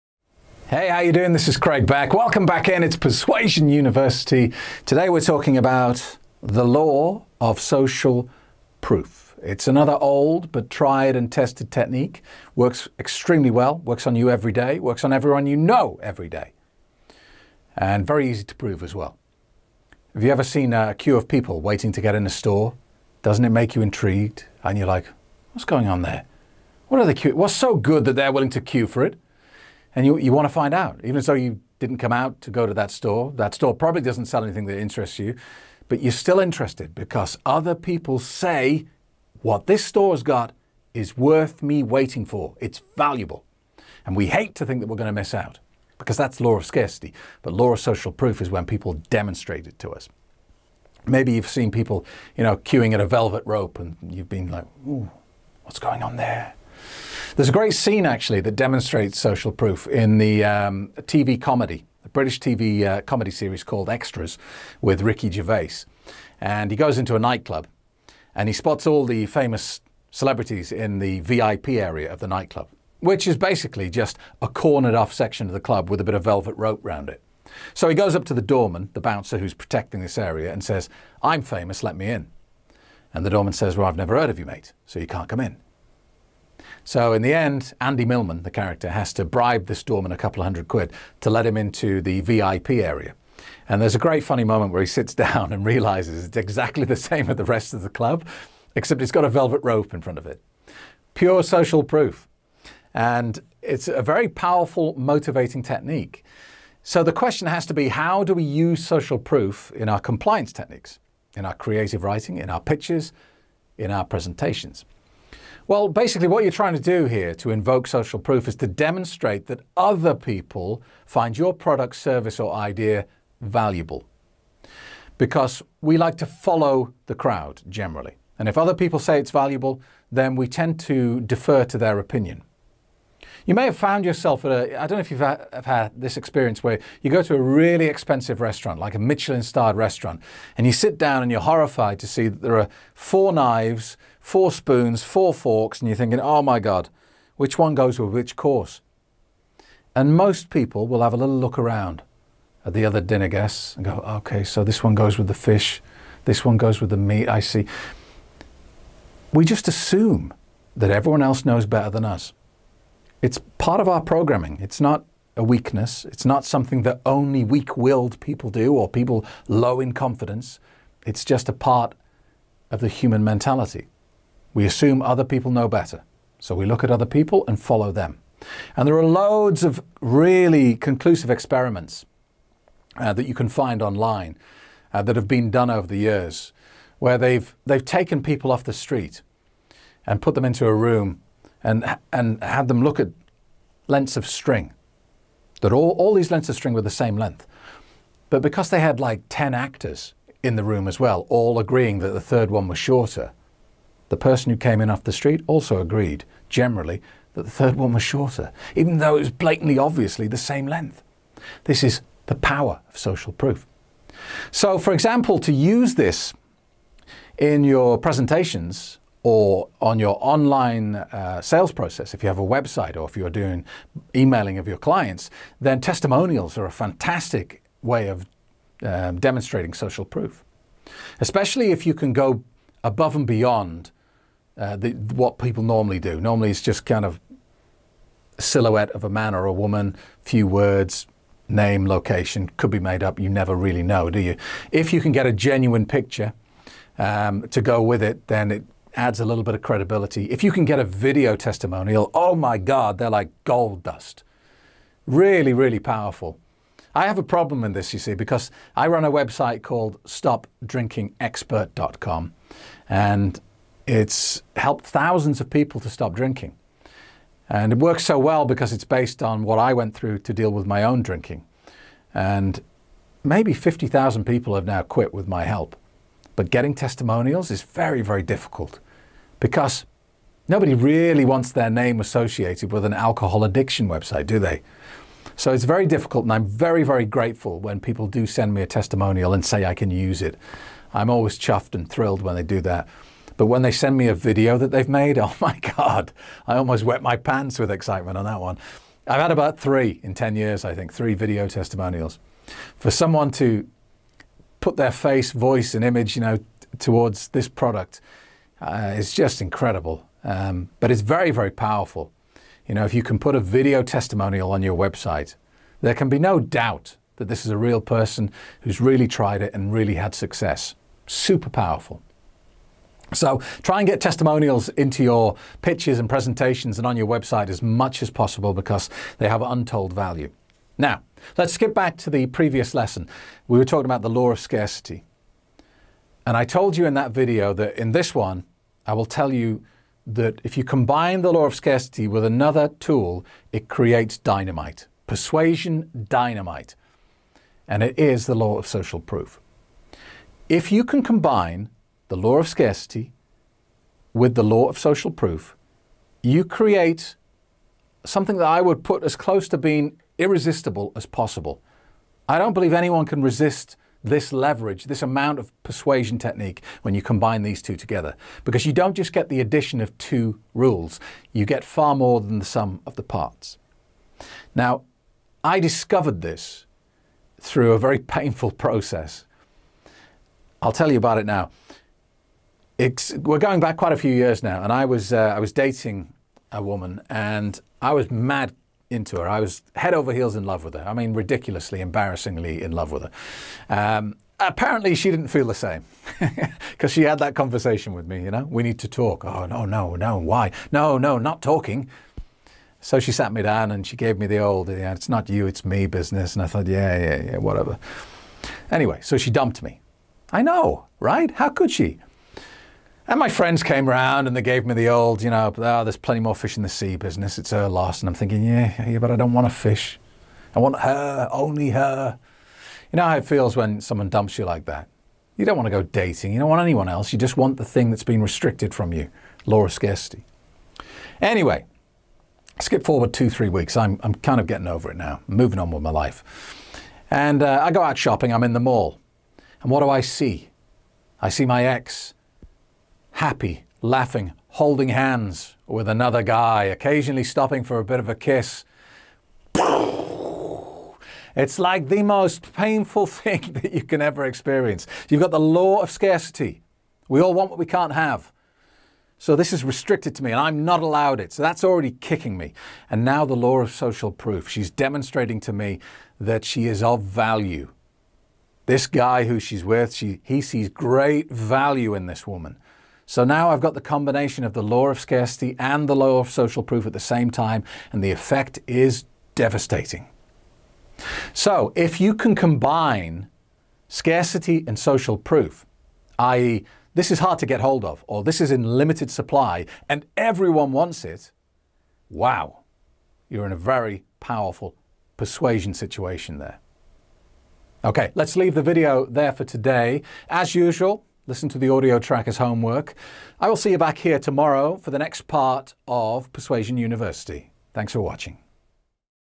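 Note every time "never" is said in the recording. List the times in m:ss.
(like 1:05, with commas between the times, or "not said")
1:23, 4:03.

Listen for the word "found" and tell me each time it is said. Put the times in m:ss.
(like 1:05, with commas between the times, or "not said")
2:13.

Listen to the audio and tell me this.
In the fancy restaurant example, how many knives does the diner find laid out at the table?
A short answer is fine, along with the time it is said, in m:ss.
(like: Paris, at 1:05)
4, at 2:22.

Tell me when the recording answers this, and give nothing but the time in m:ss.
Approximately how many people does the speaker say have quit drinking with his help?
4:33.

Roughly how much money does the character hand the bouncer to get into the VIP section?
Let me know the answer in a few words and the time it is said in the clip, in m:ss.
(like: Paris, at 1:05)
a couple of hundred quid, at 1:30.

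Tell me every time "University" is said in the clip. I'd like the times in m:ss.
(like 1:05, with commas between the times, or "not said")
0:03, 8:26.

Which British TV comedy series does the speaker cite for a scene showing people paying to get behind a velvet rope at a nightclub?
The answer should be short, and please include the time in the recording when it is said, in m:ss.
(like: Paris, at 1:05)
Extras, at 1:03.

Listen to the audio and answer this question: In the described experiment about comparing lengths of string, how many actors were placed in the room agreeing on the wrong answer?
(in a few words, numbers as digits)
10.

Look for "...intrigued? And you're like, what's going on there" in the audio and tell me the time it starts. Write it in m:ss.
0:23.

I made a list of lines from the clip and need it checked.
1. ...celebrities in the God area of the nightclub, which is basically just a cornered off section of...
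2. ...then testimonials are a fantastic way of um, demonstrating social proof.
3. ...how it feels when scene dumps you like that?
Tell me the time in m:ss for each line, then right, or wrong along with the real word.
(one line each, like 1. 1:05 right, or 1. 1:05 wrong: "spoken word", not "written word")
1. 1:10 wrong: "VIP", not "God"
2. 3:45 right
3. 7:03 wrong: "someone", not "scene".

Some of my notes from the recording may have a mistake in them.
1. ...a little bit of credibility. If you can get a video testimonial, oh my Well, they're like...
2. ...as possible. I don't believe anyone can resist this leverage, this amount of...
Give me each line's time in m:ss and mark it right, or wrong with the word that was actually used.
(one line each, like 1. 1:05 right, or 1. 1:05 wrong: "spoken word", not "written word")
1. 4:09 wrong: "God", not "Well"
2. 6:00 right.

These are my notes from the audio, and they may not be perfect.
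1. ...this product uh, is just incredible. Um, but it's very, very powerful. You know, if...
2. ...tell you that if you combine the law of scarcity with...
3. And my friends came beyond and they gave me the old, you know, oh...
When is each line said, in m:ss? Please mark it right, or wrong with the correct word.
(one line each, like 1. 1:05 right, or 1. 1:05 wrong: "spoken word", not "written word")
1. 5:07 right
2. 5:39 right
3. 6:53 wrong: "round", not "beyond".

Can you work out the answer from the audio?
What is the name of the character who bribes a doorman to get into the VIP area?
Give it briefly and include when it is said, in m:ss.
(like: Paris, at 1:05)
Andy Millman, at 1:27.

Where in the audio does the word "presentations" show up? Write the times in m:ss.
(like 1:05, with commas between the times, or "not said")
1:54, 3:37, 5:26.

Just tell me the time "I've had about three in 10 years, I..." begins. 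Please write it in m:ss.
4:59.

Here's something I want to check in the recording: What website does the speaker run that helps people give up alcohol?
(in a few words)
stopdrinkingexpert.com.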